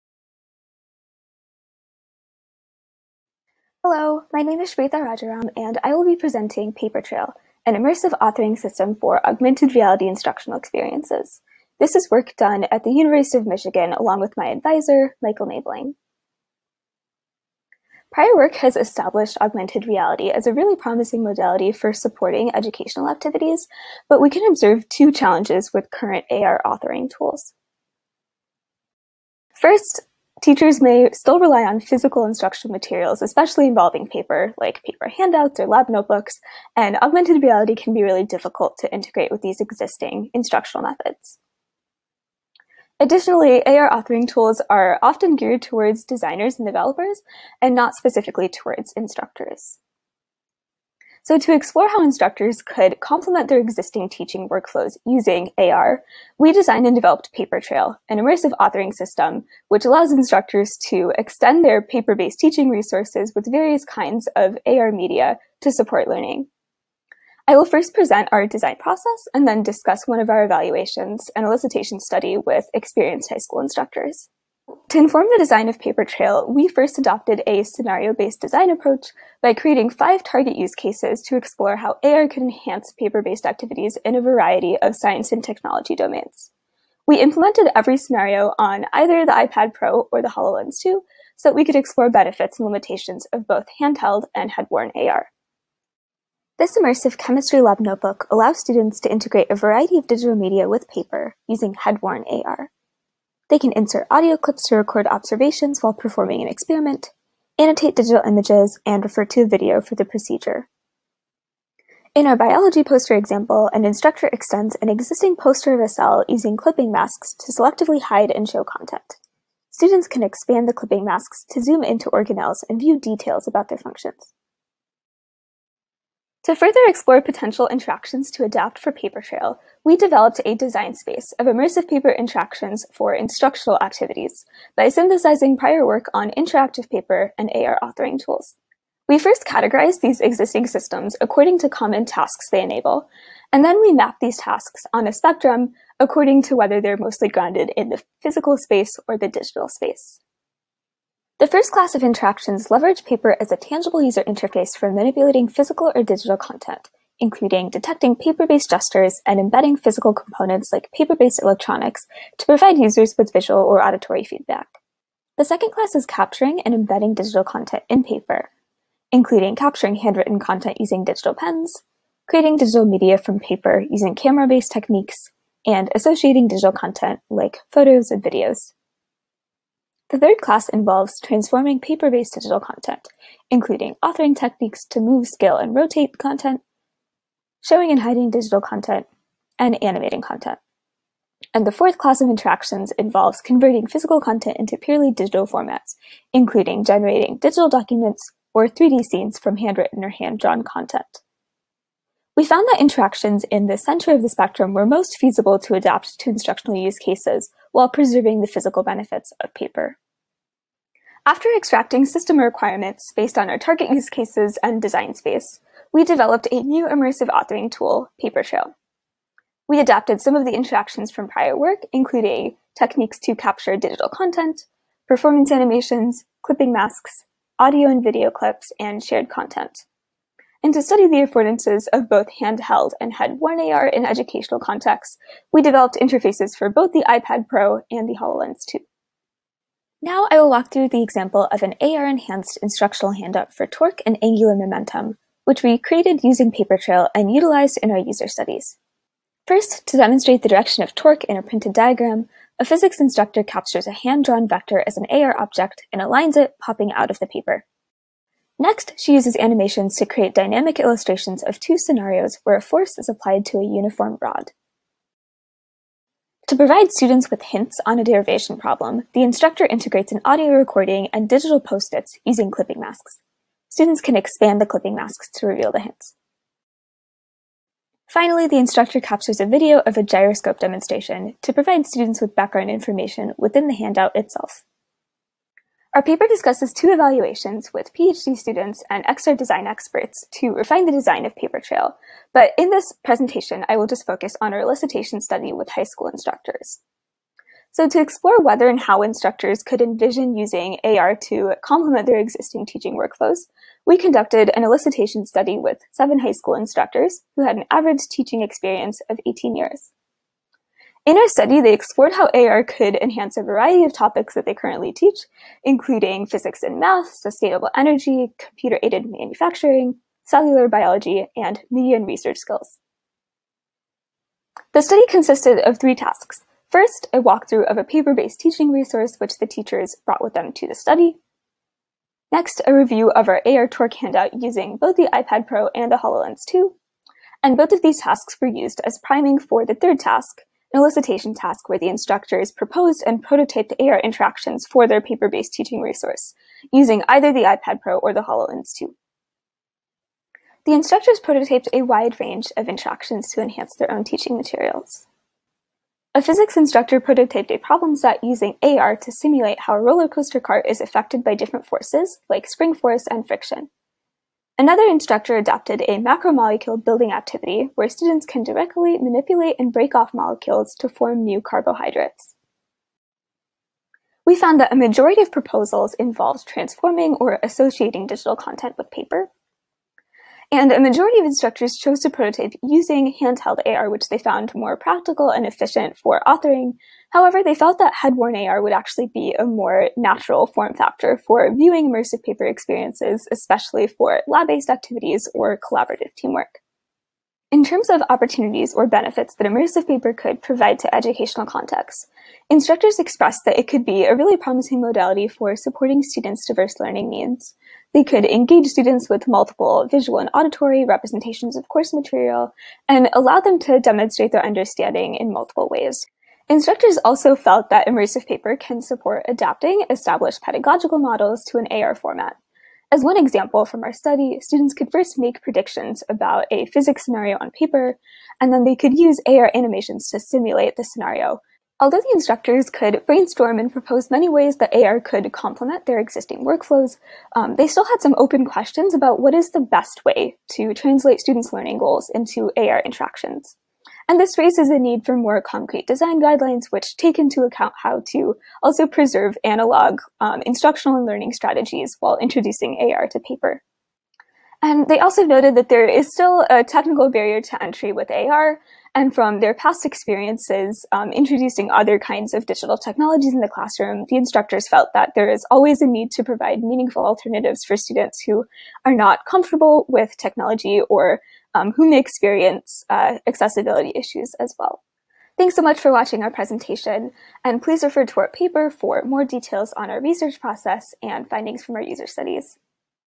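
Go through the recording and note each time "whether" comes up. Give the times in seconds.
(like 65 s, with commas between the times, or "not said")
146 s, 298 s.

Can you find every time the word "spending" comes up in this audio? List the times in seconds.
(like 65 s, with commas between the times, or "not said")
not said.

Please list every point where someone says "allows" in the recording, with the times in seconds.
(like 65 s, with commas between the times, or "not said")
59 s, 98 s, 413 s.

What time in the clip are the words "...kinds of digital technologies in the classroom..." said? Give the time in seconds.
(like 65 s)
461 s.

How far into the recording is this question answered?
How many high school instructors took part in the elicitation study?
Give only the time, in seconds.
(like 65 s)
305 s.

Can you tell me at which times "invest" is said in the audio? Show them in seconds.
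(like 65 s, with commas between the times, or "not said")
not said.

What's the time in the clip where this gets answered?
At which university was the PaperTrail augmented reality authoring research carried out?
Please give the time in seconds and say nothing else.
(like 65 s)
12 s.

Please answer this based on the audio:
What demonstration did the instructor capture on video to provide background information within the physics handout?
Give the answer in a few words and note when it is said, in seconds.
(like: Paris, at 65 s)
gyroscope demonstration, at 280 s.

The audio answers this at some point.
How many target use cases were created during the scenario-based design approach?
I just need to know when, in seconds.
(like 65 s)
79 s.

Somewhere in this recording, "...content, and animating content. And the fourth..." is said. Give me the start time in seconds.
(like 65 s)
188 s.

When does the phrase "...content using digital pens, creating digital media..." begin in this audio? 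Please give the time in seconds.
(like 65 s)
170 s.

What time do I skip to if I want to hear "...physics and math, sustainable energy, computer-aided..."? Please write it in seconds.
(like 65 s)
316 s.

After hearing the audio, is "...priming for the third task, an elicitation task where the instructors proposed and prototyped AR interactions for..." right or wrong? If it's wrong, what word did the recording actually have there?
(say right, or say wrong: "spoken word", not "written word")
right.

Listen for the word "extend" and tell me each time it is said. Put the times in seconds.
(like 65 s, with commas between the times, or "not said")
61 s, 114 s.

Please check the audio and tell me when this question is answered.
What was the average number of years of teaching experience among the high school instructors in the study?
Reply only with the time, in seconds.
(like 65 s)
309 s.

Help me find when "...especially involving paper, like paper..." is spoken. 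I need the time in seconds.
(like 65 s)
33 s.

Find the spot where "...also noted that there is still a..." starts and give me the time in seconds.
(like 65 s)
454 s.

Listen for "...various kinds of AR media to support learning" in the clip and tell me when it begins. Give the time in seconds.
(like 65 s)
63 s.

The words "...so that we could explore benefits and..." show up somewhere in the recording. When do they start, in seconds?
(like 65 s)
91 s.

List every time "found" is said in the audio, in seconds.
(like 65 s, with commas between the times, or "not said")
202 s, 374 s, 384 s.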